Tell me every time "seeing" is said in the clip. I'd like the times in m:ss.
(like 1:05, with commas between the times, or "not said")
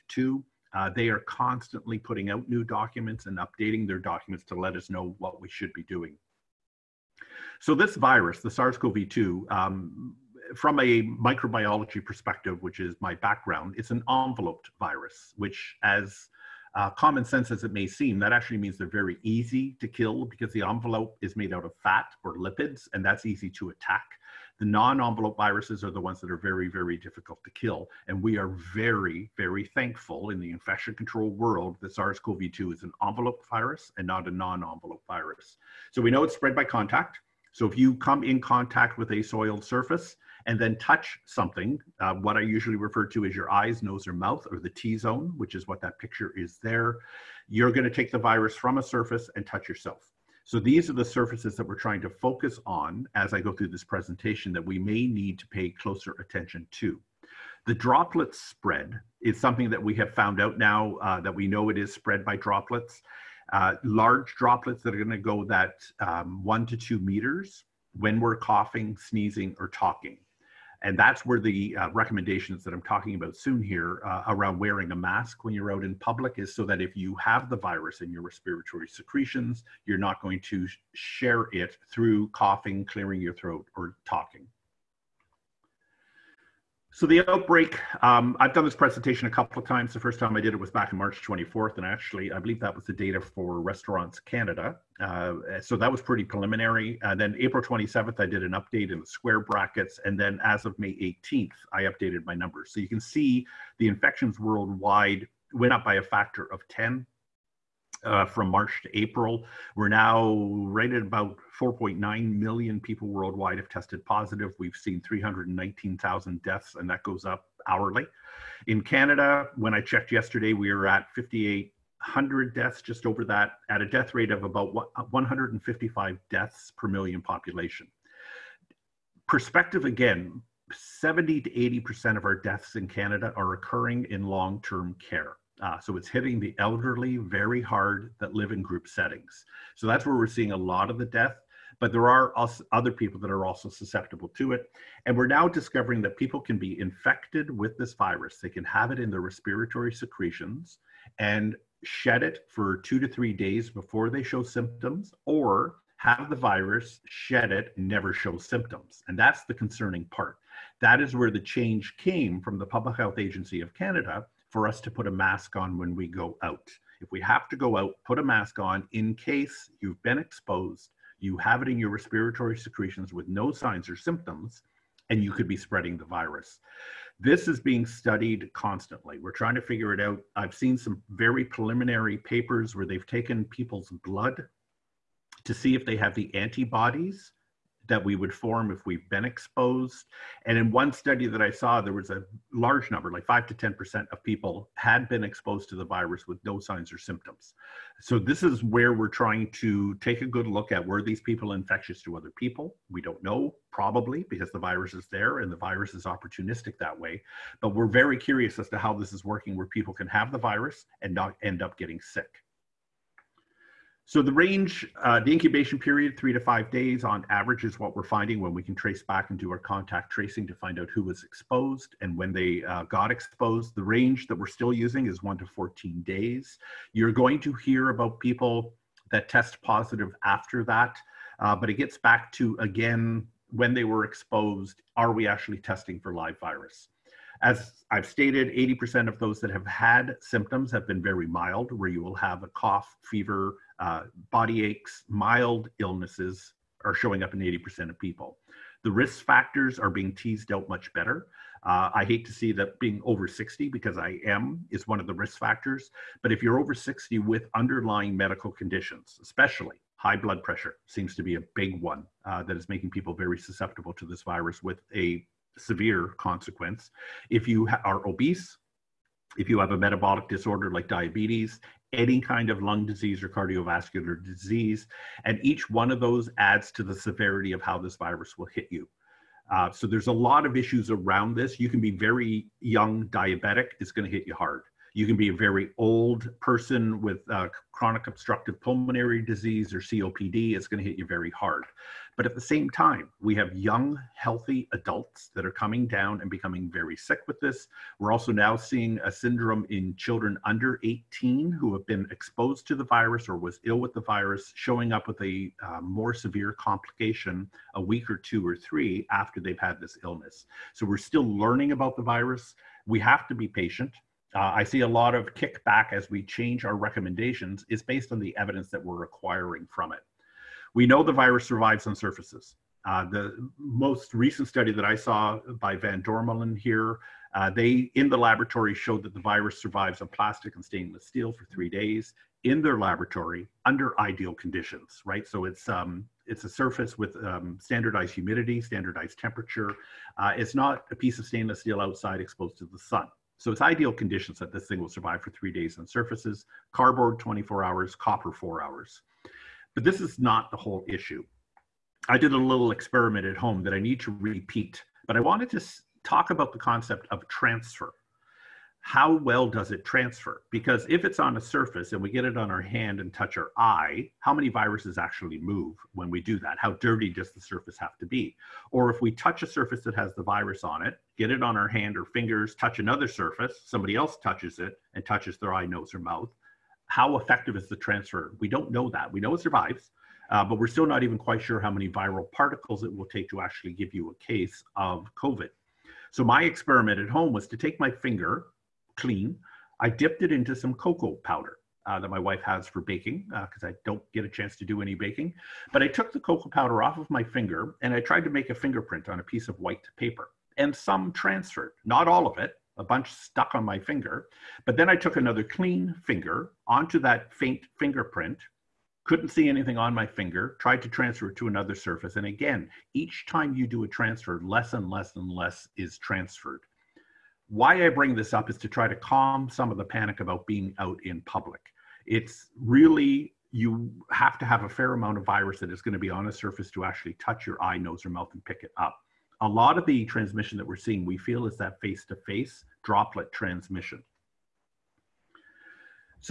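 2:20, 4:58, 7:10.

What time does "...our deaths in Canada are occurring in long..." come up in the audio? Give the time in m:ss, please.
2:12.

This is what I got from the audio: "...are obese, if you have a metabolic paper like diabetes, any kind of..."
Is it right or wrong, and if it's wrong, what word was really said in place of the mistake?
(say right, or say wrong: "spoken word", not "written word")
wrong: "disorder", not "paper".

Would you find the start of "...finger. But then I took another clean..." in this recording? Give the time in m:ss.
6:43.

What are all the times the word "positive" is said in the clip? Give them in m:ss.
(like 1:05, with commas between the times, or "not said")
1:54, 3:49.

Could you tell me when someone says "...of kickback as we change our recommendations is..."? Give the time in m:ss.
5:15.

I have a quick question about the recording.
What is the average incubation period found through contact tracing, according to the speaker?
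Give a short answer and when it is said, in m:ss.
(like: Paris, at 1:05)
3 to 5 days, at 3:36.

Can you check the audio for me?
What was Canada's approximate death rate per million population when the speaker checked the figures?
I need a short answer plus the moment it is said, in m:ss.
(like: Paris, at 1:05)
155, at 2:05.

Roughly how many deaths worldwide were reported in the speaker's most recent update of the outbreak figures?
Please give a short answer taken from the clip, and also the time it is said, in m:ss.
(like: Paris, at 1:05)
319,000, at 1:55.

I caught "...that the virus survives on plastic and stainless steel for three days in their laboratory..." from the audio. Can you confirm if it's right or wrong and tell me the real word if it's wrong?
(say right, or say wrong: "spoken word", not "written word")
right.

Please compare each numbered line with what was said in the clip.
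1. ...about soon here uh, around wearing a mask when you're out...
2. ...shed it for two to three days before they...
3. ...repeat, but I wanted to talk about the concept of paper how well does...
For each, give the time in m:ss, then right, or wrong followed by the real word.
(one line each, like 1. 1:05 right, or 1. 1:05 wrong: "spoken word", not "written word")
1. 1:13 right
2. 2:31 right
3. 5:54 wrong: "transfer", not "paper".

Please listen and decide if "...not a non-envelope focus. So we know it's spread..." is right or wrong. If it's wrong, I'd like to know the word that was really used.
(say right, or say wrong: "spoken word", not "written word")
wrong: "virus", not "focus".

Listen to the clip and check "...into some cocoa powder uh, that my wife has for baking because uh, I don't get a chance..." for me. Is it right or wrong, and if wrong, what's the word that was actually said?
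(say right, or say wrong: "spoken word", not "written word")
right.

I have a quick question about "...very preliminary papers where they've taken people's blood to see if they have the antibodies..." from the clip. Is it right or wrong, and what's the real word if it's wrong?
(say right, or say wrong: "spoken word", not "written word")
right.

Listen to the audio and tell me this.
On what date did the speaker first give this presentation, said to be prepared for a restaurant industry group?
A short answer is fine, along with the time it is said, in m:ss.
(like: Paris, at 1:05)
March 24th, at 1:30.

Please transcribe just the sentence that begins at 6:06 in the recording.
How dirty does the surface have to be?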